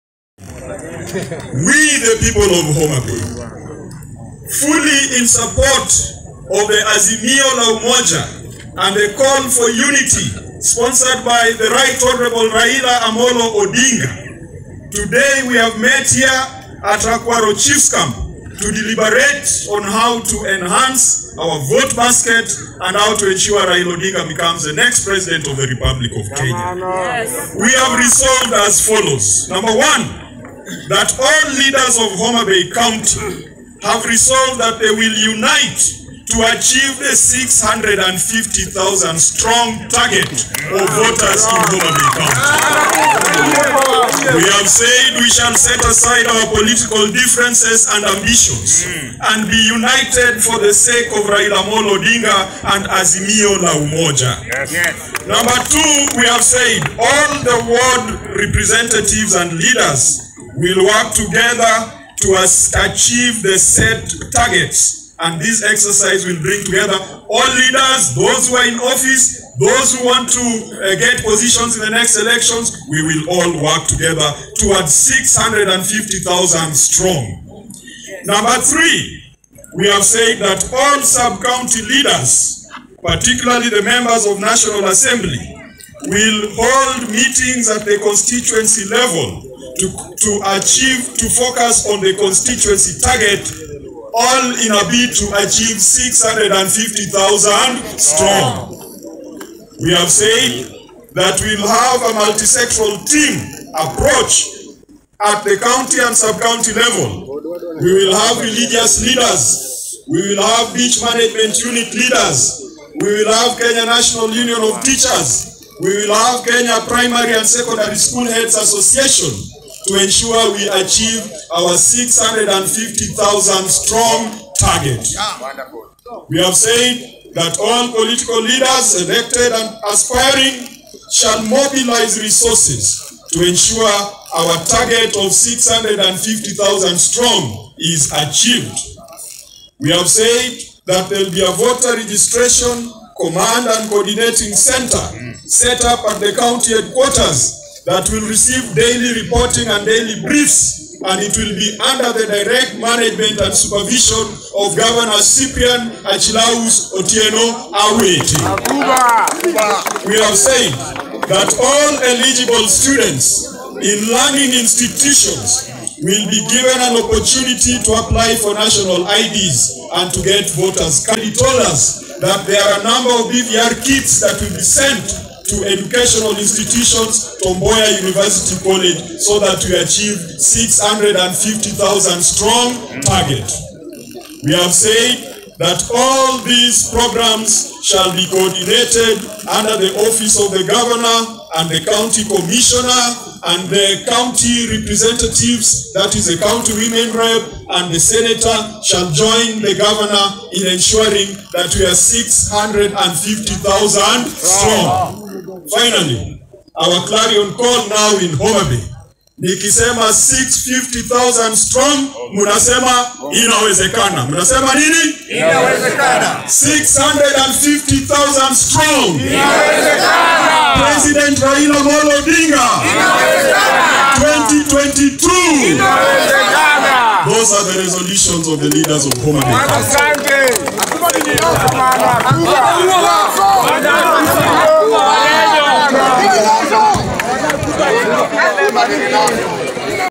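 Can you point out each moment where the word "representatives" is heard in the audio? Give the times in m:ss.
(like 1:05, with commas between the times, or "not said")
0:58, 3:14.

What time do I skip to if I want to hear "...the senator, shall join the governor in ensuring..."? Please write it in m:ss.
3:17.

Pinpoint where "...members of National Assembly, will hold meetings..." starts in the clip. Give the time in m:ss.
1:23.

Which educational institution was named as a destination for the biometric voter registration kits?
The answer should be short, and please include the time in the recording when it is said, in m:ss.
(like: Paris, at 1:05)
Tom Mboya University College, at 2:57.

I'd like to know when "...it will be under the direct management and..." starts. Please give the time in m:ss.
2:31.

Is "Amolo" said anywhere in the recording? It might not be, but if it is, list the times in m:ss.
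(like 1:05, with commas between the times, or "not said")
0:13, 0:51, 3:41.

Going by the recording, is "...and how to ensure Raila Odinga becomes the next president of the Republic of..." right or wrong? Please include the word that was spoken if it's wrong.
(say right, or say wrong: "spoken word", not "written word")
right.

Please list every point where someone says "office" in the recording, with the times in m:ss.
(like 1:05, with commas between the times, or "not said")
1:08, 3:10.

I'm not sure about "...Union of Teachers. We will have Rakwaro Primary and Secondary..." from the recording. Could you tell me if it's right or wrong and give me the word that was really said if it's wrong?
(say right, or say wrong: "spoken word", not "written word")
wrong: "Kenya", not "Rakwaro".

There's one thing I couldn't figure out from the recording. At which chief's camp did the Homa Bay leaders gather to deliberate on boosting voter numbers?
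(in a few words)
Rakwaro Chiefs Camp.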